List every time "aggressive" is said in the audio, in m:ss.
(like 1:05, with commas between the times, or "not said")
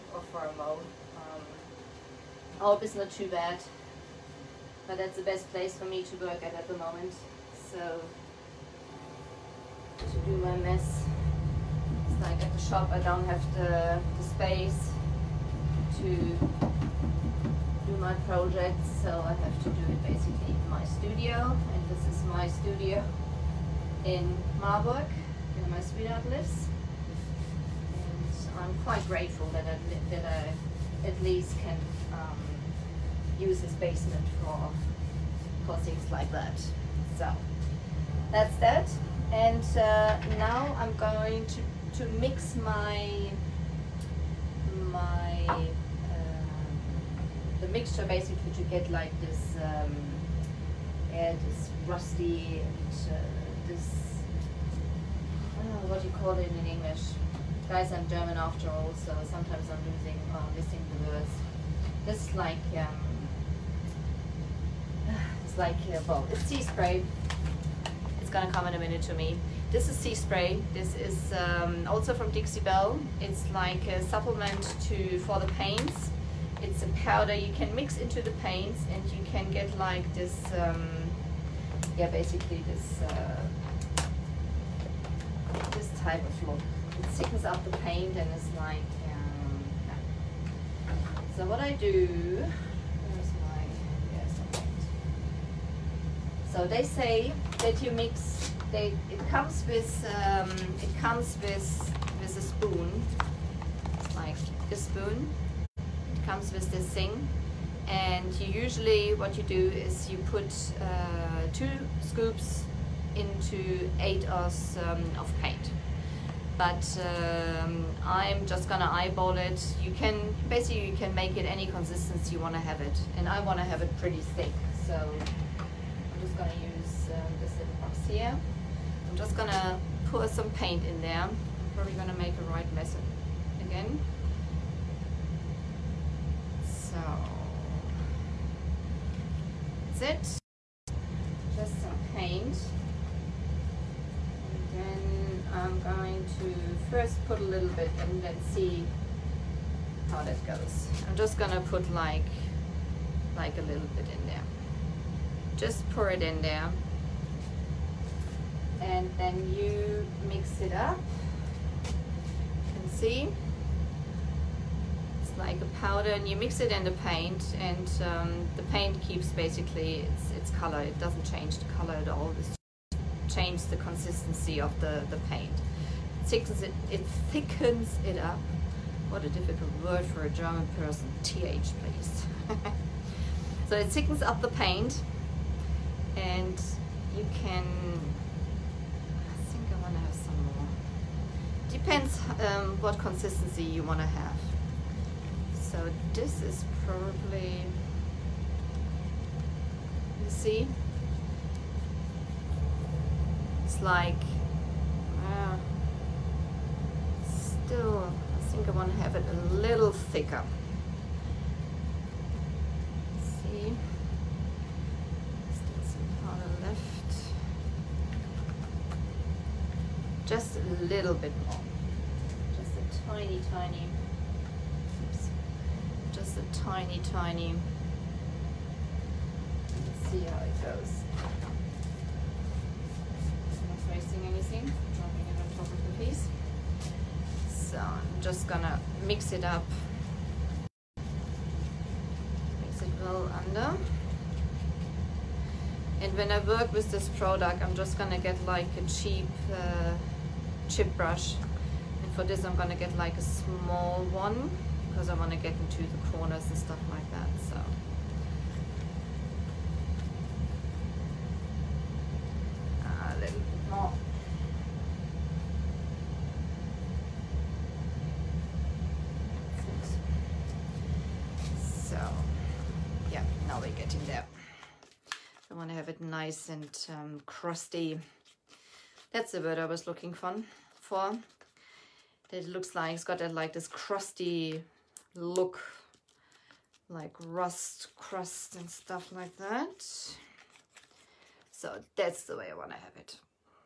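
not said.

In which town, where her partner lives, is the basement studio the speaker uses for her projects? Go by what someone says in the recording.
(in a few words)
Marburg.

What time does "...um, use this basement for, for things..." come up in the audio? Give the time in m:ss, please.
0:32.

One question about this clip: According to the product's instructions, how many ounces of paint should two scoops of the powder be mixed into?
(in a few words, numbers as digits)
8 oz.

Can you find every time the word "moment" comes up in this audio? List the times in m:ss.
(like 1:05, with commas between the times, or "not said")
0:00, 0:06.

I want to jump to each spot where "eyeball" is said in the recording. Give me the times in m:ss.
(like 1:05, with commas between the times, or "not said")
1:58.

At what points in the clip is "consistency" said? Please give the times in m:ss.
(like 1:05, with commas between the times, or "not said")
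2:01, 2:53, 3:12.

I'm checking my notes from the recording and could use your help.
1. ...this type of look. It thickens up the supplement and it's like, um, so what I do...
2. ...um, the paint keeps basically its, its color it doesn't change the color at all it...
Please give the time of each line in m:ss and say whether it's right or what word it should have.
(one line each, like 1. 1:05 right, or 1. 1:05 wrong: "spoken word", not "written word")
1. 1:25 wrong: "paint", not "supplement"
2. 2:48 right.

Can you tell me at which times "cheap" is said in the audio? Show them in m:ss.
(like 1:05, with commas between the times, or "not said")
4:08.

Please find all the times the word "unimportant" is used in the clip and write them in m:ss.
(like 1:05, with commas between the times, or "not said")
not said.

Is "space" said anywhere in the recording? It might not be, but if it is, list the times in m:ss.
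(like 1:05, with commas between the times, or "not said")
0:14.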